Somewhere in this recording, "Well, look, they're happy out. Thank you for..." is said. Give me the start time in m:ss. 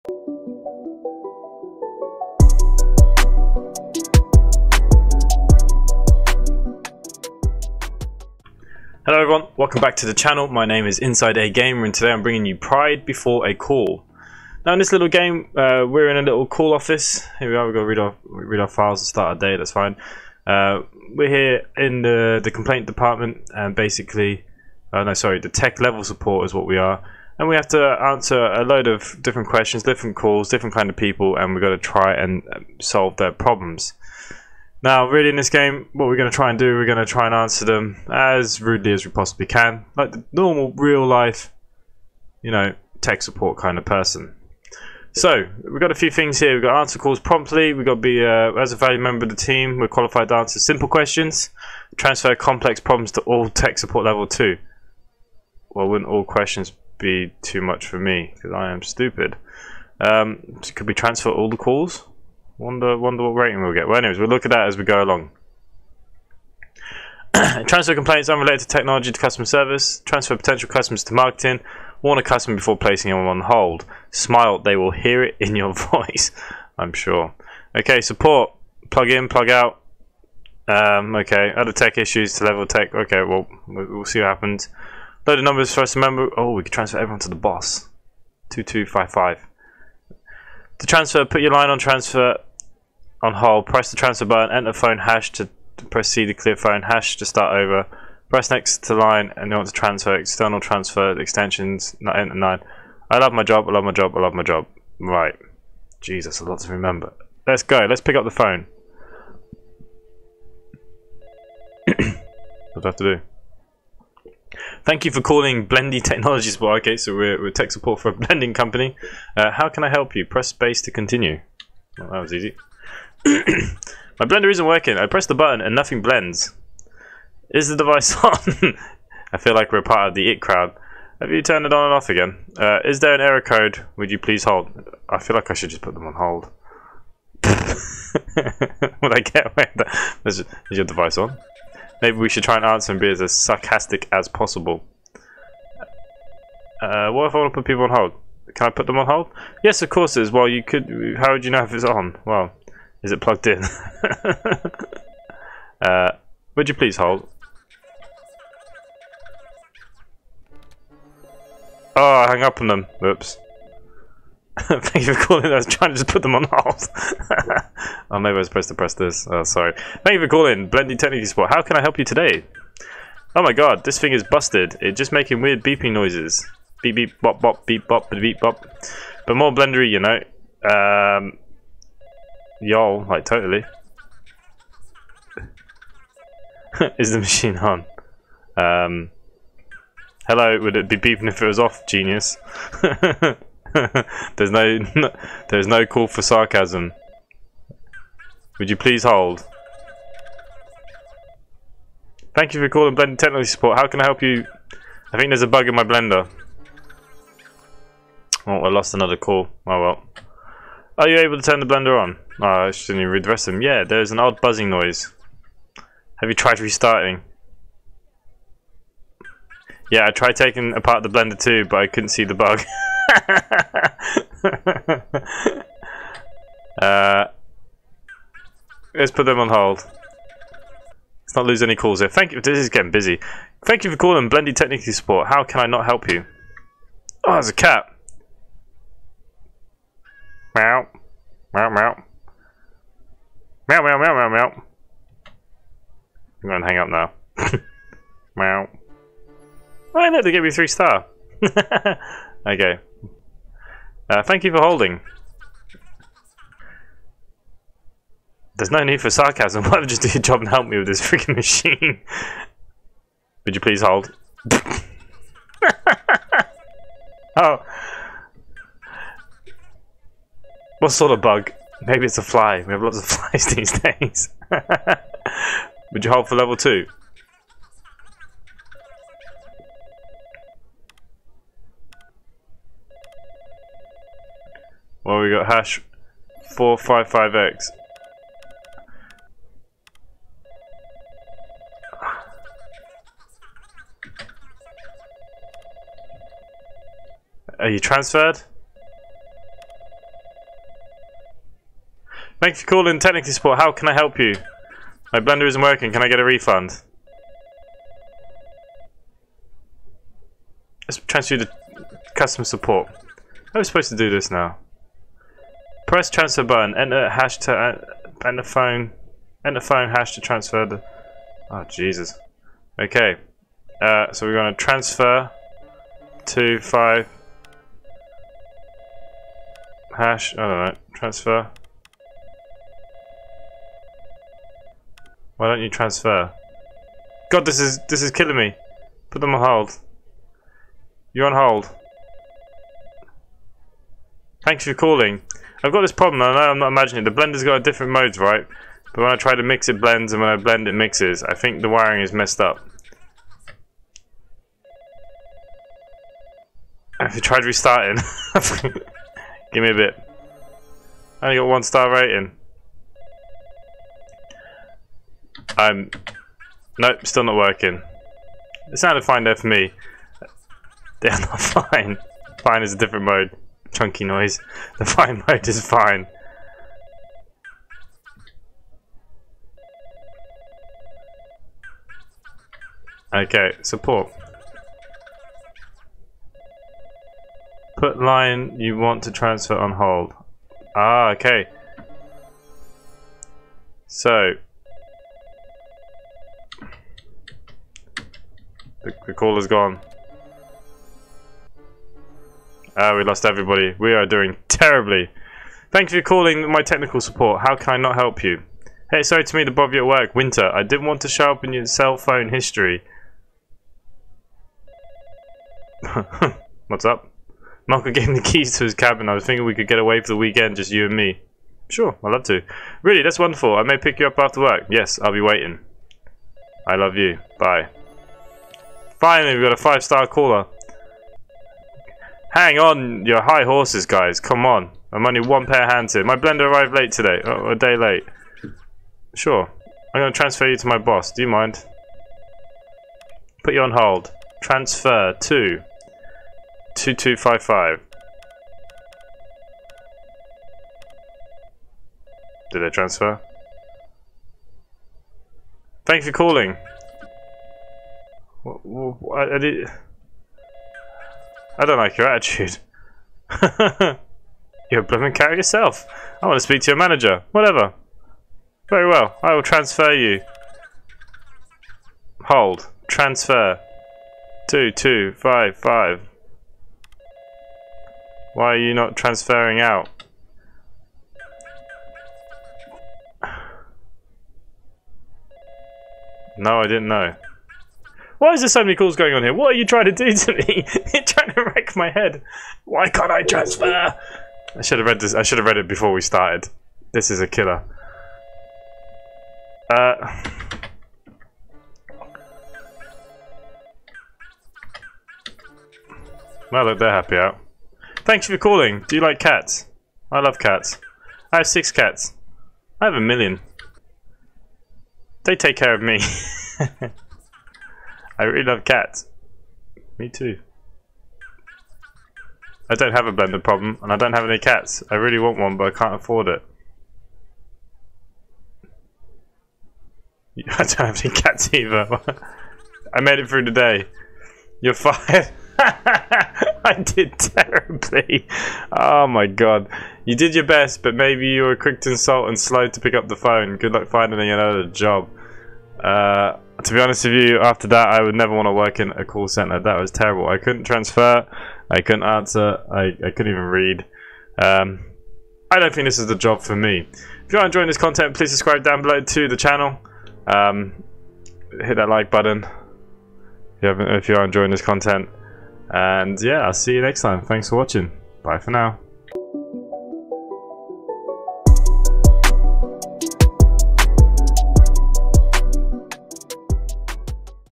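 8:26.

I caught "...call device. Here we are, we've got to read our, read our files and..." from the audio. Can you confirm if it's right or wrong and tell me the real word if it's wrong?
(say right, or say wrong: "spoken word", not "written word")
wrong: "office", not "device".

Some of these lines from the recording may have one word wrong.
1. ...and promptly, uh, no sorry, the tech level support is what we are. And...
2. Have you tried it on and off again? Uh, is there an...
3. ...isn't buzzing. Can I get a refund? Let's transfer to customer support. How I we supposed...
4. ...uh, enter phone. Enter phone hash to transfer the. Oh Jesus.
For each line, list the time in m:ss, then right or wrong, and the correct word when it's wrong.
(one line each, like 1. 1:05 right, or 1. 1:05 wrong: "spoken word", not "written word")
1. 0:23 wrong: "basically", not "promptly"
2. 2:11 wrong: "turned", not "tried"
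3. 5:05 wrong: "working", not "buzzing"
4. 5:17 right.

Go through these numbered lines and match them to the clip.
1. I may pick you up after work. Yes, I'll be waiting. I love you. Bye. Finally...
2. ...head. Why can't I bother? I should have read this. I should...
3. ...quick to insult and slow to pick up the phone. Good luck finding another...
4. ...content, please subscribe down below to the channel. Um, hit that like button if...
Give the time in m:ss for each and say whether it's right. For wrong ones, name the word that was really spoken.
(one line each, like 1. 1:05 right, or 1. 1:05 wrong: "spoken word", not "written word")
1. 7:03 right
2. 8:11 wrong: "transfer", not "bother"
3. 9:01 right
4. 9:17 right.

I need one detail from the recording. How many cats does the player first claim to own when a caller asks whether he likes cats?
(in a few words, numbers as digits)
6.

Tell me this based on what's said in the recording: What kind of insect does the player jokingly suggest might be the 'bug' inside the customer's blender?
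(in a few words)
A fly.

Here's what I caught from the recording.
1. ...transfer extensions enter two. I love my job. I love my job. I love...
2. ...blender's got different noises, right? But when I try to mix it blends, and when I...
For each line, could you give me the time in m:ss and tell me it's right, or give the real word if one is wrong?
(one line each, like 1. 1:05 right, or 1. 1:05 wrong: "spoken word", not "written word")
1. 1:40 wrong: "nine", not "two"
2. 5:47 wrong: "modes", not "noises".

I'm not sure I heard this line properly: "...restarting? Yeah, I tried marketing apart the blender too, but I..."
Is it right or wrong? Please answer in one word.
wrong.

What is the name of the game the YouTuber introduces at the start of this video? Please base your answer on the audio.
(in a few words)
Pride Before a Call.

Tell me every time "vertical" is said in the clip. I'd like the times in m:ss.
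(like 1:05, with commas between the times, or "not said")
not said.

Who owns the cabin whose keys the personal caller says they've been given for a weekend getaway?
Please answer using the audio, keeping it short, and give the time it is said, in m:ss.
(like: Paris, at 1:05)
Michael, at 6:57.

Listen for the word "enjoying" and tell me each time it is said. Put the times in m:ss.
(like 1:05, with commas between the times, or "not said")
9:17, 9:24.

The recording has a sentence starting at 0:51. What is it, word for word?
Transfer complex problems to all tech support level 2.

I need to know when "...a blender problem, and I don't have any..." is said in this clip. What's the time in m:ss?
8:43.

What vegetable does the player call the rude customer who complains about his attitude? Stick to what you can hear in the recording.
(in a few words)
Carrot.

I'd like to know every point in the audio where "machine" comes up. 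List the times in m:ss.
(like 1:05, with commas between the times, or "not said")
3:07, 4:21.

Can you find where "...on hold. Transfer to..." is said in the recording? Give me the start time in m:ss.
7:23.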